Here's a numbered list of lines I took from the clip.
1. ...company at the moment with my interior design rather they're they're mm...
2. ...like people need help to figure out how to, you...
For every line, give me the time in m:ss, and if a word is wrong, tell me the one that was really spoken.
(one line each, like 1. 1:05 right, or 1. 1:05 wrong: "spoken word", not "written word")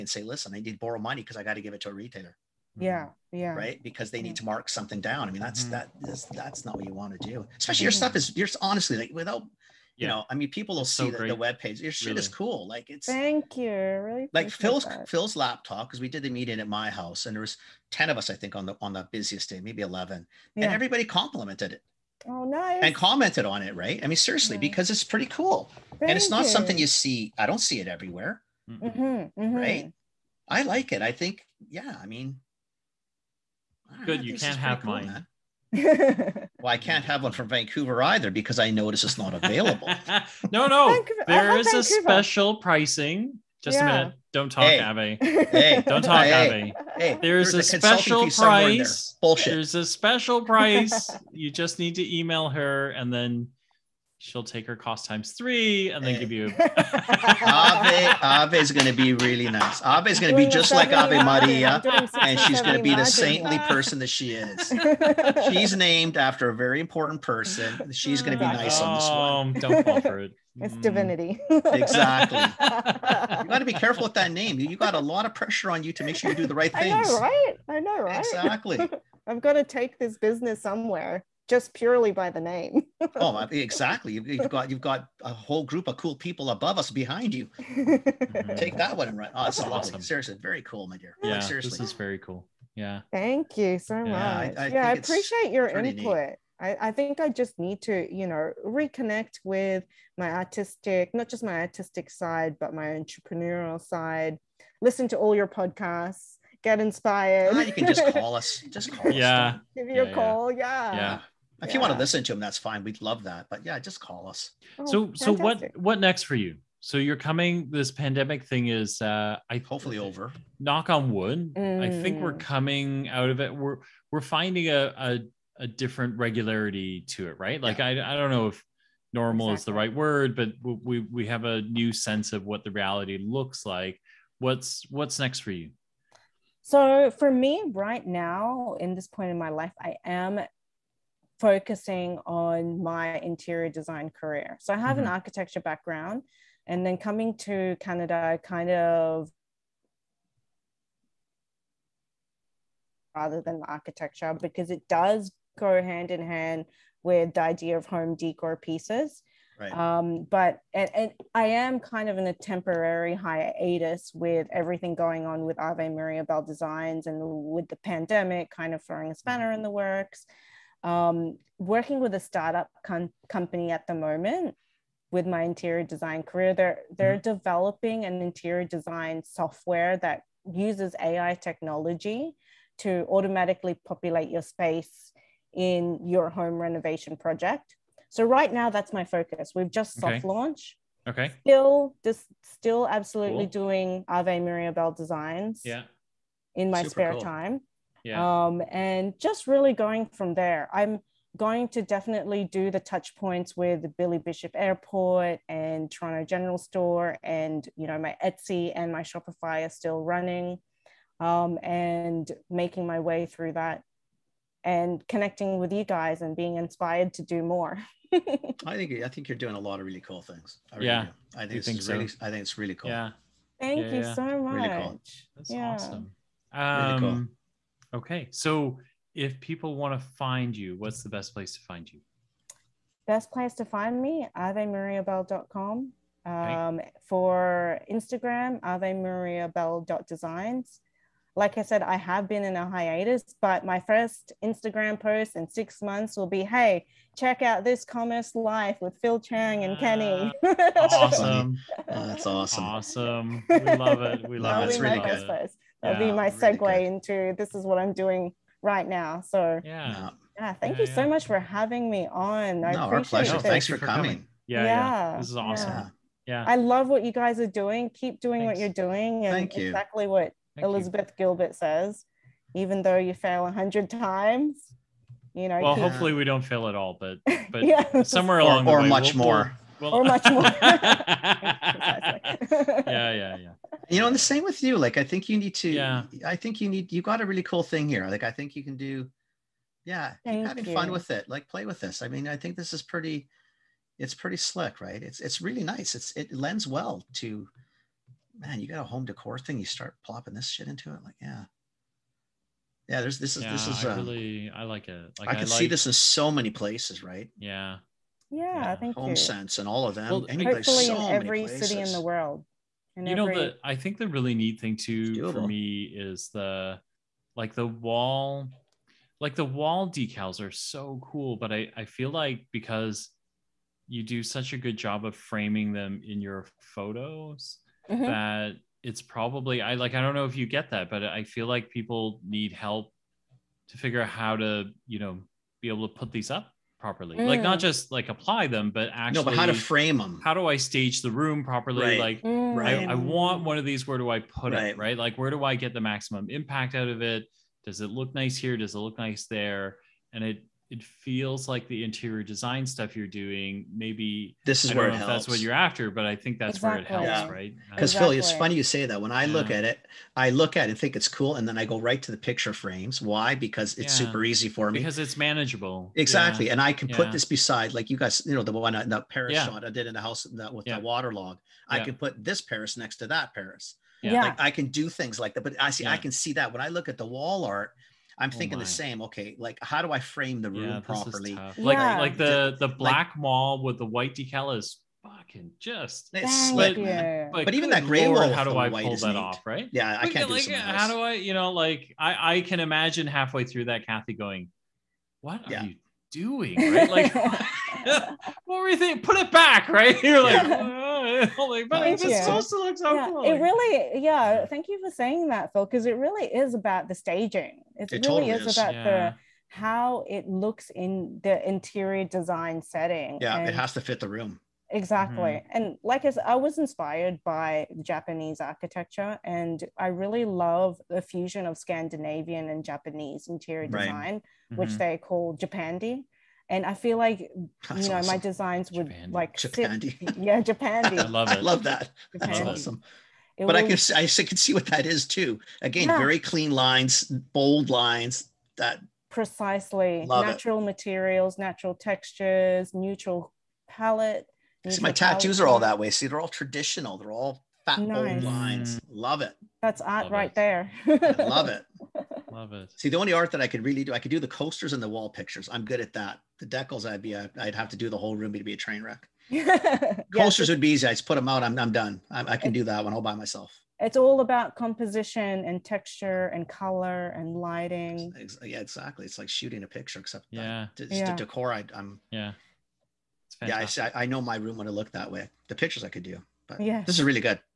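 1. 2:53 wrong: "career", not "rather"
2. 5:31 right.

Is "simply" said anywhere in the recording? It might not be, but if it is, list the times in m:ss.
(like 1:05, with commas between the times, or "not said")
not said.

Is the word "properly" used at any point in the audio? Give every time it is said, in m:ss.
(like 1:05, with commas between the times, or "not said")
5:36, 5:41, 6:20.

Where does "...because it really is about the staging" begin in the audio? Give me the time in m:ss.
6:45.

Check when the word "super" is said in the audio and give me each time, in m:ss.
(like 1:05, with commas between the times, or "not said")
3:16, 6:04.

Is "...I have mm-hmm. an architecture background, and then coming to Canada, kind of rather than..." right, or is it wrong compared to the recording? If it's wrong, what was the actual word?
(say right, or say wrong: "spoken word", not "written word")
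right.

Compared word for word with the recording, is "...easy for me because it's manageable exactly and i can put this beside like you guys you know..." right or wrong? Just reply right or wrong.
right.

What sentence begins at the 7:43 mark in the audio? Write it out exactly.
It's all about composition and texture and color and lighting.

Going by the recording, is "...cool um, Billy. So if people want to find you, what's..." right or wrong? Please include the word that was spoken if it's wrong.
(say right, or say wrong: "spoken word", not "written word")
wrong: "Okay", not "Billy".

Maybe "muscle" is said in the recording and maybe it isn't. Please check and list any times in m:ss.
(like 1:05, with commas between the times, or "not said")
not said.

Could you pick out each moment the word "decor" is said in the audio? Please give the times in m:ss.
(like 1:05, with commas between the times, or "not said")
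2:38, 4:59, 7:51.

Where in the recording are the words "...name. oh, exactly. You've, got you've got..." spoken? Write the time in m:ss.
1:22.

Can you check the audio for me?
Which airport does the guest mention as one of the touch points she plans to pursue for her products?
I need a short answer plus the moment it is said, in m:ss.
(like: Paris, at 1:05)
Billy Bishop Airport, at 3:23.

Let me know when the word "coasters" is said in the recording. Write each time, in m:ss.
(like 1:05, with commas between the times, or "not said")
7:34, 7:40.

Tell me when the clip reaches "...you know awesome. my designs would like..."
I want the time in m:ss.
7:07.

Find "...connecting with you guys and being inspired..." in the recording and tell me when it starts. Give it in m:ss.
3:35.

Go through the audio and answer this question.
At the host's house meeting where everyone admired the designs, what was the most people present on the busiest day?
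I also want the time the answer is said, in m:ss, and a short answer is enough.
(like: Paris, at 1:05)
11, at 0:19.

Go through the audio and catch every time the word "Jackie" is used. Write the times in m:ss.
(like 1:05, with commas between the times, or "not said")
not said.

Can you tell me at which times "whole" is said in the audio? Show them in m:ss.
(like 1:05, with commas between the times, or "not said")
1:25, 7:37.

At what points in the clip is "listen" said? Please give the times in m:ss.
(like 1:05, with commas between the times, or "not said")
0:00, 1:44, 1:51.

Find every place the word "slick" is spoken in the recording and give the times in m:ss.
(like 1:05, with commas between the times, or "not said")
4:54, 6:26.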